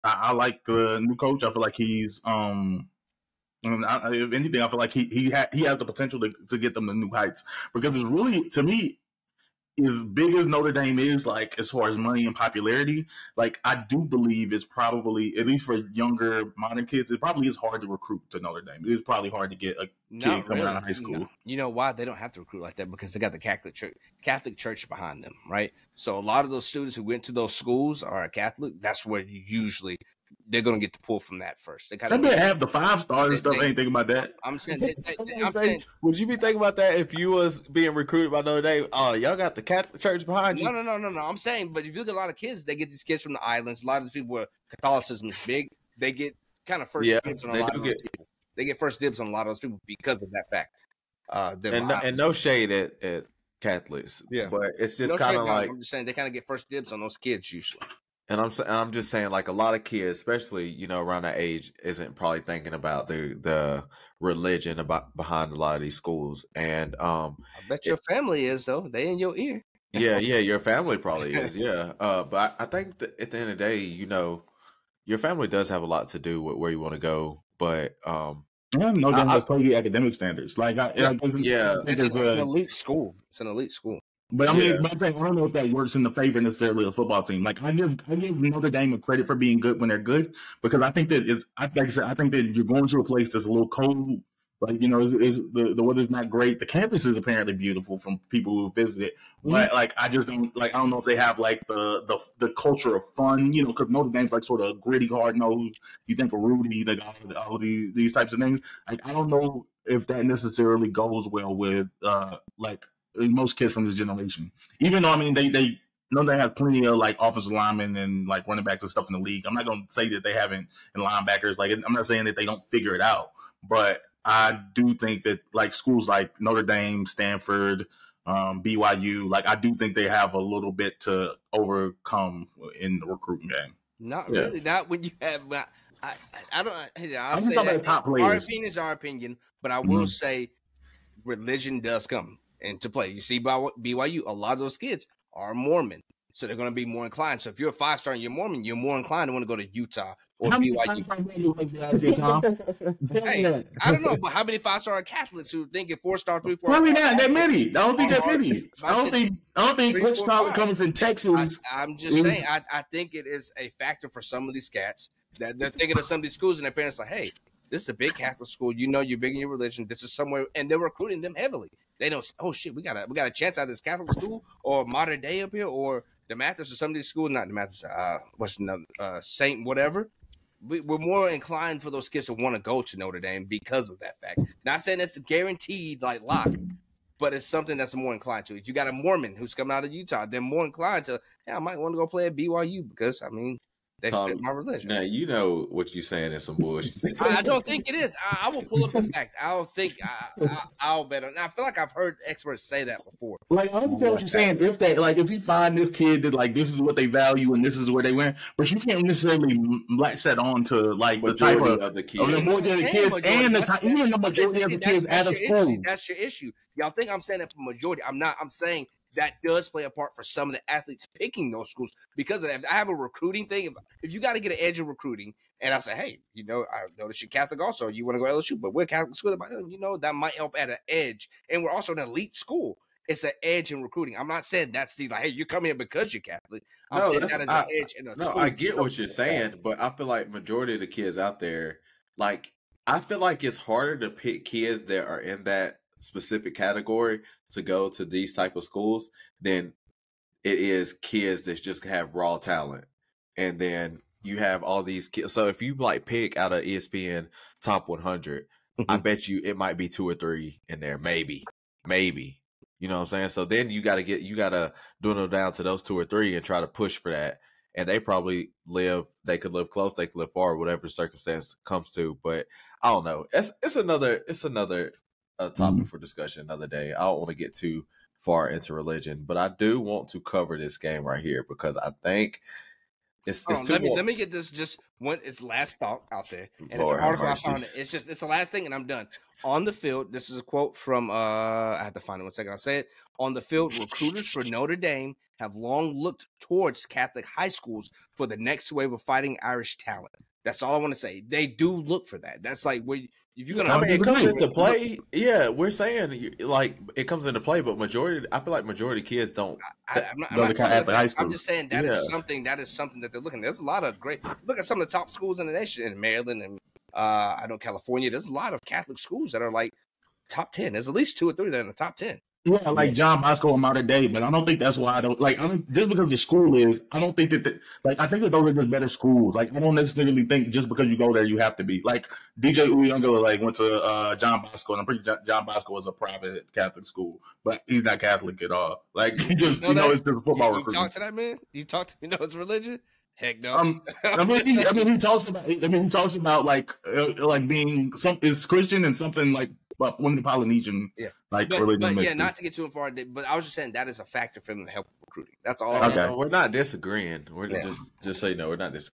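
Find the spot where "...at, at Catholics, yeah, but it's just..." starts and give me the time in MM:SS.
00:52.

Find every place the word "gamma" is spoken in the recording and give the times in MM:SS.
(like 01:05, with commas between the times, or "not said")
not said.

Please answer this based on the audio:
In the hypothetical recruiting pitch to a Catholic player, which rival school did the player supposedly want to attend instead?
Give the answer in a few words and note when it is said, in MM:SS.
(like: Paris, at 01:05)
LSU, at 03:48.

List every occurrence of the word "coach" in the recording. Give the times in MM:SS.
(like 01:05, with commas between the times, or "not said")
00:01.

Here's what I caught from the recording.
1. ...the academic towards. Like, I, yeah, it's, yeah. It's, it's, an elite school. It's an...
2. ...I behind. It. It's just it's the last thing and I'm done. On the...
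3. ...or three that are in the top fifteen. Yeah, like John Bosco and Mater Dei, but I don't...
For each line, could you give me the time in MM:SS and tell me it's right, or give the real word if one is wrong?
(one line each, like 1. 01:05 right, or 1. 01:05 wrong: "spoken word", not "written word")
1. 01:19 wrong: "standards", not "towards"
2. 04:47 wrong: "found", not "behind"
3. 05:21 wrong: "ten", not "fifteen".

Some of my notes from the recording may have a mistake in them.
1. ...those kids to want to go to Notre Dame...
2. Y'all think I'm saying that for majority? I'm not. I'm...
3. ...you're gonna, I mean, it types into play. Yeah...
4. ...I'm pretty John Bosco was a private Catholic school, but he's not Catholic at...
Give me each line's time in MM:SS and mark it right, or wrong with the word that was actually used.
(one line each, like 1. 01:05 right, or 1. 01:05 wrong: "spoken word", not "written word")
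1. 03:01 right
2. 03:36 right
3. 05:03 wrong: "comes", not "types"
4. 05:34 right.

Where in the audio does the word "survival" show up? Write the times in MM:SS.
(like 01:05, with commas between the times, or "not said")
not said.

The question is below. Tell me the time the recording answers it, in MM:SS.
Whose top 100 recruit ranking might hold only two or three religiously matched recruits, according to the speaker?
04:16.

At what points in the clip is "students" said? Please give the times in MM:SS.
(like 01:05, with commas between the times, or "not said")
00:26.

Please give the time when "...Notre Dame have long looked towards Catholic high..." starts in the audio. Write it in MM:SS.
04:54.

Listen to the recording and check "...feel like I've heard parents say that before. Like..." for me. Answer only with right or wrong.
wrong.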